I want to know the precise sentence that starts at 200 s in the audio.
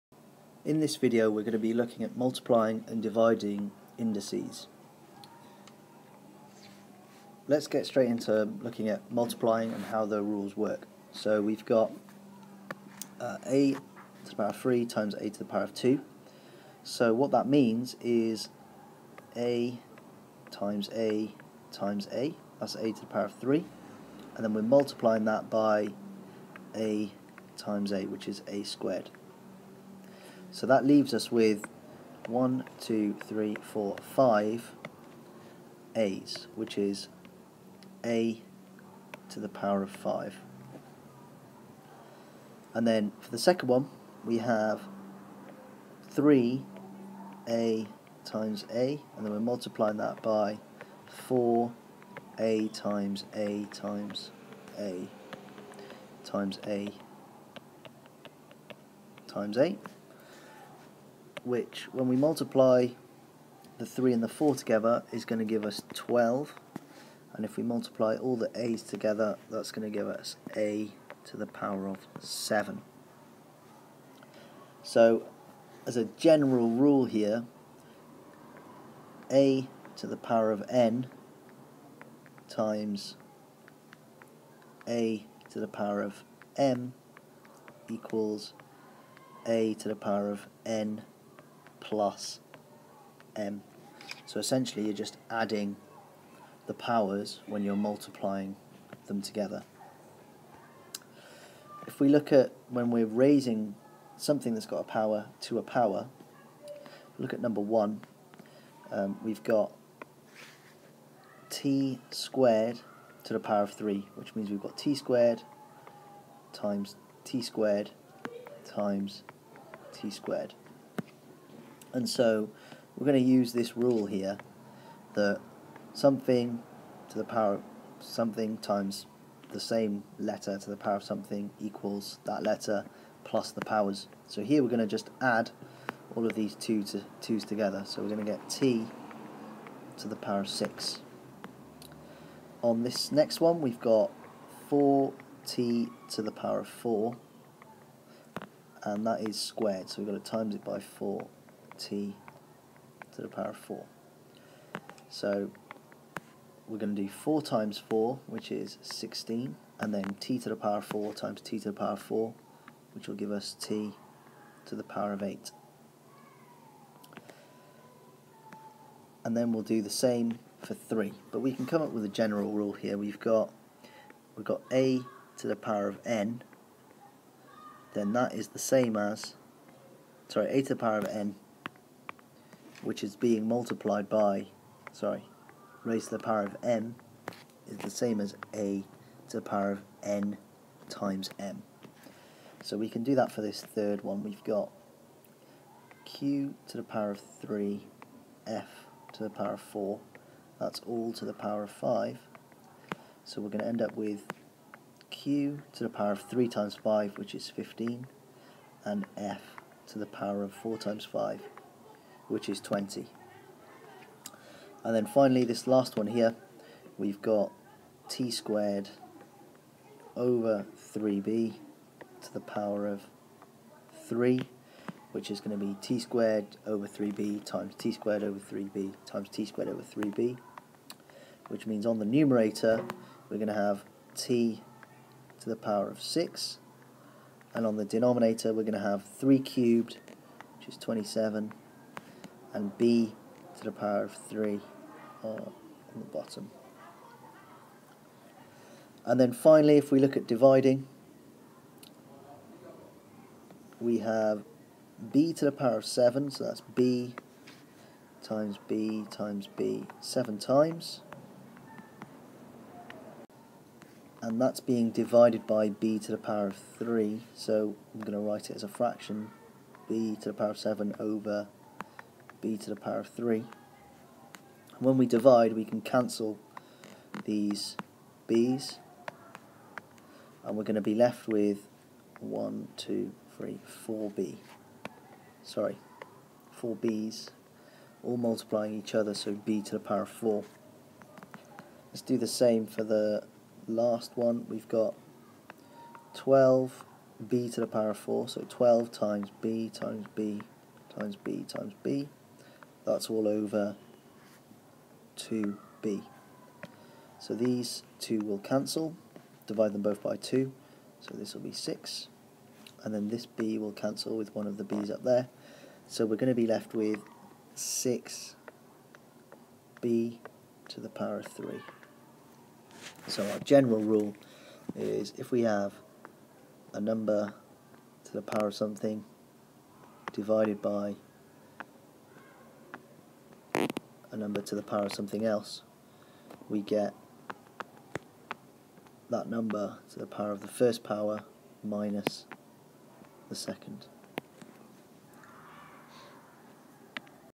That's all to the power of 5.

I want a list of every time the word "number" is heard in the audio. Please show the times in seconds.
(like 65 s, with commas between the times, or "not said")
107 s, 326 s, 334 s, 339 s.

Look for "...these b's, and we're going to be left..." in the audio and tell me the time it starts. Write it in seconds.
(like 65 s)
277 s.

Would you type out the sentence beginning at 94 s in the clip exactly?
So essentially you're just adding the powers when you're multiplying them together.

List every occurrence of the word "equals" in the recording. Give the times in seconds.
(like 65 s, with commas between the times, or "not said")
87 s, 131 s.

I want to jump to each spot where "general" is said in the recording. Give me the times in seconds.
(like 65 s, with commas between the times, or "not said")
76 s, 172 s, 323 s.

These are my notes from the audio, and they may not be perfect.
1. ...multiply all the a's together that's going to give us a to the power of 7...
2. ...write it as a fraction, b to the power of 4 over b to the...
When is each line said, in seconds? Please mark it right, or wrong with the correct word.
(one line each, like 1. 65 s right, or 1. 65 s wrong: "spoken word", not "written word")
1. 67 s right
2. 268 s wrong: "7", not "4".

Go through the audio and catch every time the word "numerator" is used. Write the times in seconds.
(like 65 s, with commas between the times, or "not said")
232 s.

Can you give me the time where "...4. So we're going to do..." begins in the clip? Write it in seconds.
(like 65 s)
153 s.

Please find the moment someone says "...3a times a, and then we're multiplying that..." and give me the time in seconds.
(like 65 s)
46 s.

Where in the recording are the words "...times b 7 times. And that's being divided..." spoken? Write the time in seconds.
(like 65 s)
259 s.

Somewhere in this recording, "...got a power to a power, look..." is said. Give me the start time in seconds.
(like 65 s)
104 s.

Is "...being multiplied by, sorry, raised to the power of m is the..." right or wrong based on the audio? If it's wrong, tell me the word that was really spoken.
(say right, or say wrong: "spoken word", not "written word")
right.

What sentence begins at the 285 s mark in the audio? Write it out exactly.
Sorry, 4 b's, all multiplying each other, so b to the power of 4.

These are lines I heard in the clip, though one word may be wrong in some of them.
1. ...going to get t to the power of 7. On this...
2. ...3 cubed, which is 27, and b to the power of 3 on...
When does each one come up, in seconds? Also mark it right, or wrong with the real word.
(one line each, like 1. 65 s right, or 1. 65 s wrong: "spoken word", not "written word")
1. 138 s wrong: "6", not "7"
2. 239 s right.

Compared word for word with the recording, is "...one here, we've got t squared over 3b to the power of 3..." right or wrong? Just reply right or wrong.
right.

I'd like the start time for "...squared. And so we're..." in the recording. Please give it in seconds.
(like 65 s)
120 s.